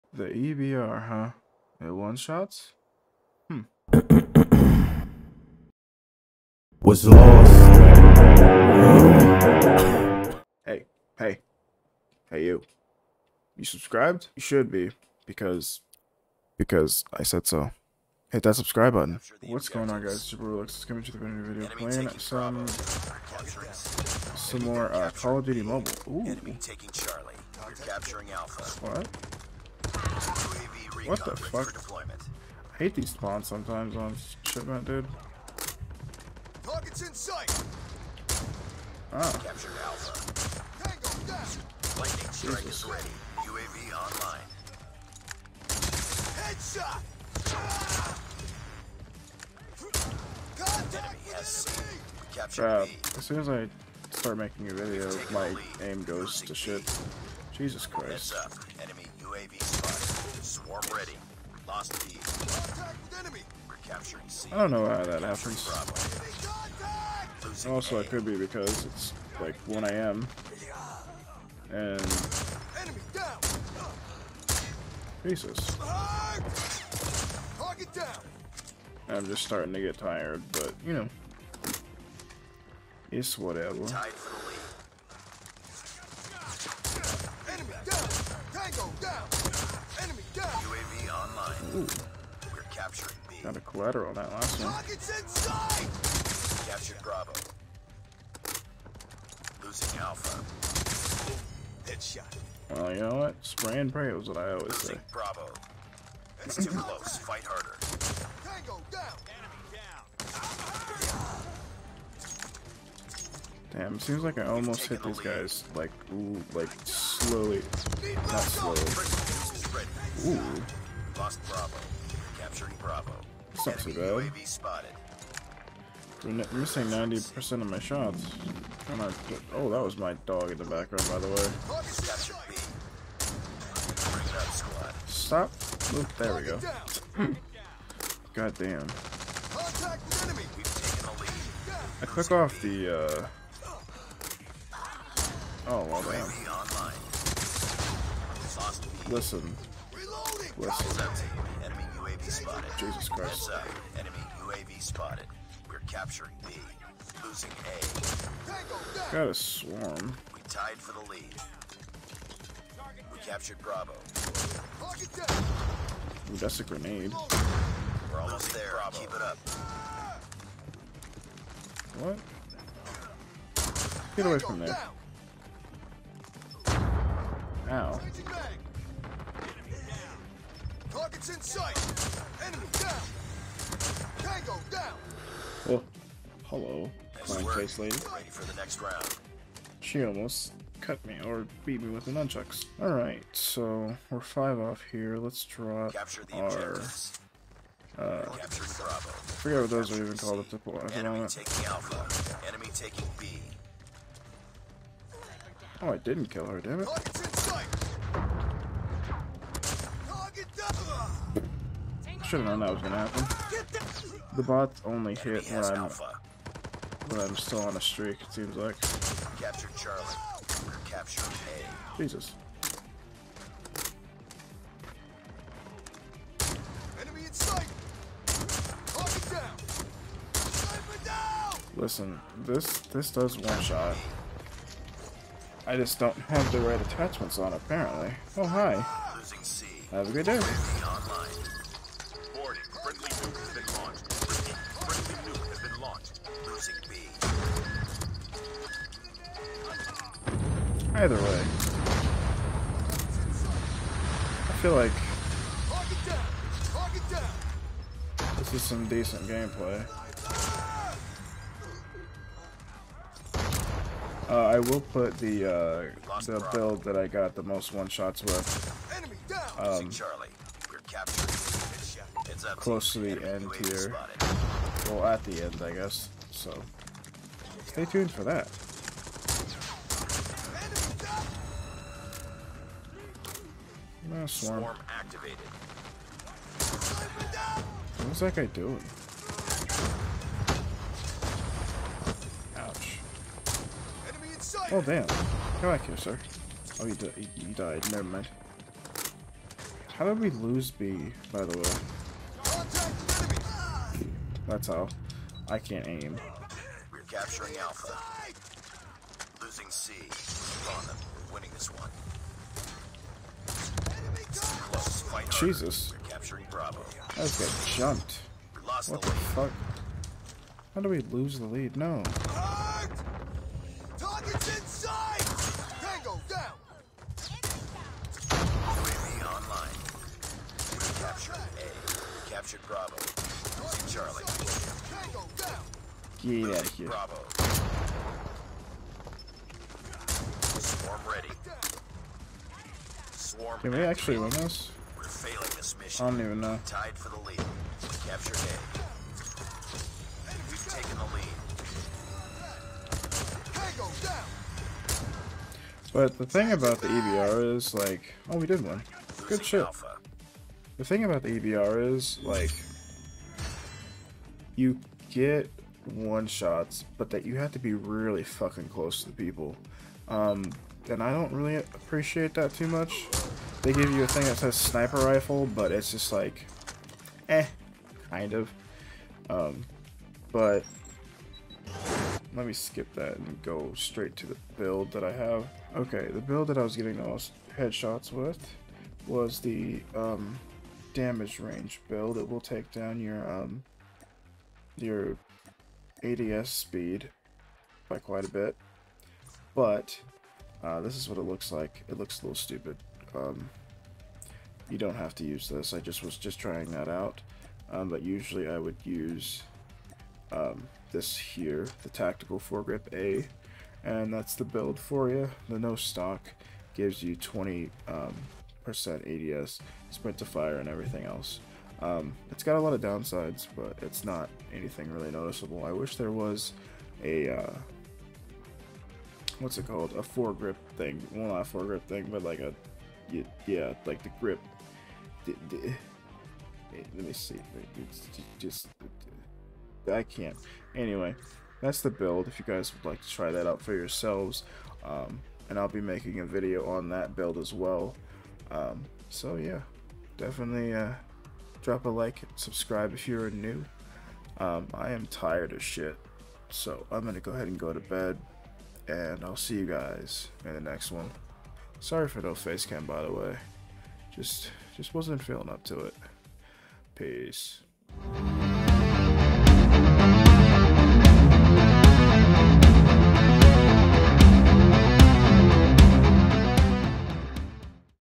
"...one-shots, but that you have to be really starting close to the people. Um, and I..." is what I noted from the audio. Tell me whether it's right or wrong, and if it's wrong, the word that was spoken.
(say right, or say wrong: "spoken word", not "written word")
wrong: "fucking", not "starting".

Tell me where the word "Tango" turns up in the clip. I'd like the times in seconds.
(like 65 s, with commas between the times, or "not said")
40 s, 88 s, 108 s, 184 s.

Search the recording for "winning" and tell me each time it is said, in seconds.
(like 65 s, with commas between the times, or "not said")
311 s.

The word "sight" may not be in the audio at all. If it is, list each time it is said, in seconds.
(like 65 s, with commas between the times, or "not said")
37 s, 181 s, 227 s.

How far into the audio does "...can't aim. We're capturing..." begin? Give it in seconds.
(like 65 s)
305 s.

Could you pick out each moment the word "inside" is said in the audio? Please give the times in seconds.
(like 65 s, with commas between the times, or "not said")
95 s.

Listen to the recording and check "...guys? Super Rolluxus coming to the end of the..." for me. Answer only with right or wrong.
right.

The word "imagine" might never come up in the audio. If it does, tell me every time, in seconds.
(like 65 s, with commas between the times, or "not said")
not said.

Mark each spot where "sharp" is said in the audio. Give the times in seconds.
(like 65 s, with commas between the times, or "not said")
not said.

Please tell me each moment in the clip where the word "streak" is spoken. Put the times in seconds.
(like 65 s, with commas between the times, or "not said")
217 s.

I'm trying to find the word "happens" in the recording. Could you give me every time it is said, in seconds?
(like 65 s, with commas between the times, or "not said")
65 s, 212 s.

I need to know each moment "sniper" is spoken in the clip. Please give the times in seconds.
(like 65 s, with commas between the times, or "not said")
374 s.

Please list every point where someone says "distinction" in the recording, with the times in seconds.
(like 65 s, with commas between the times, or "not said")
not said.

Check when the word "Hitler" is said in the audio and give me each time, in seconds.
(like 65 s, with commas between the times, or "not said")
not said.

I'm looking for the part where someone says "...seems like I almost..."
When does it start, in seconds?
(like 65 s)
113 s.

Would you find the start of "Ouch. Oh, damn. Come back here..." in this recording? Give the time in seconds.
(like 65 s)
292 s.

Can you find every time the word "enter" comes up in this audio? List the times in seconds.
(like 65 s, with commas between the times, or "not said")
not said.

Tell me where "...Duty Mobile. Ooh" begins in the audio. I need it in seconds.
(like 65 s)
25 s.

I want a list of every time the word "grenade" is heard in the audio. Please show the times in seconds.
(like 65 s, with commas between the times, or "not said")
166 s.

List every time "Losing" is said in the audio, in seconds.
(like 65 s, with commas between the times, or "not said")
99 s, 157 s, 246 s, 309 s, 333 s.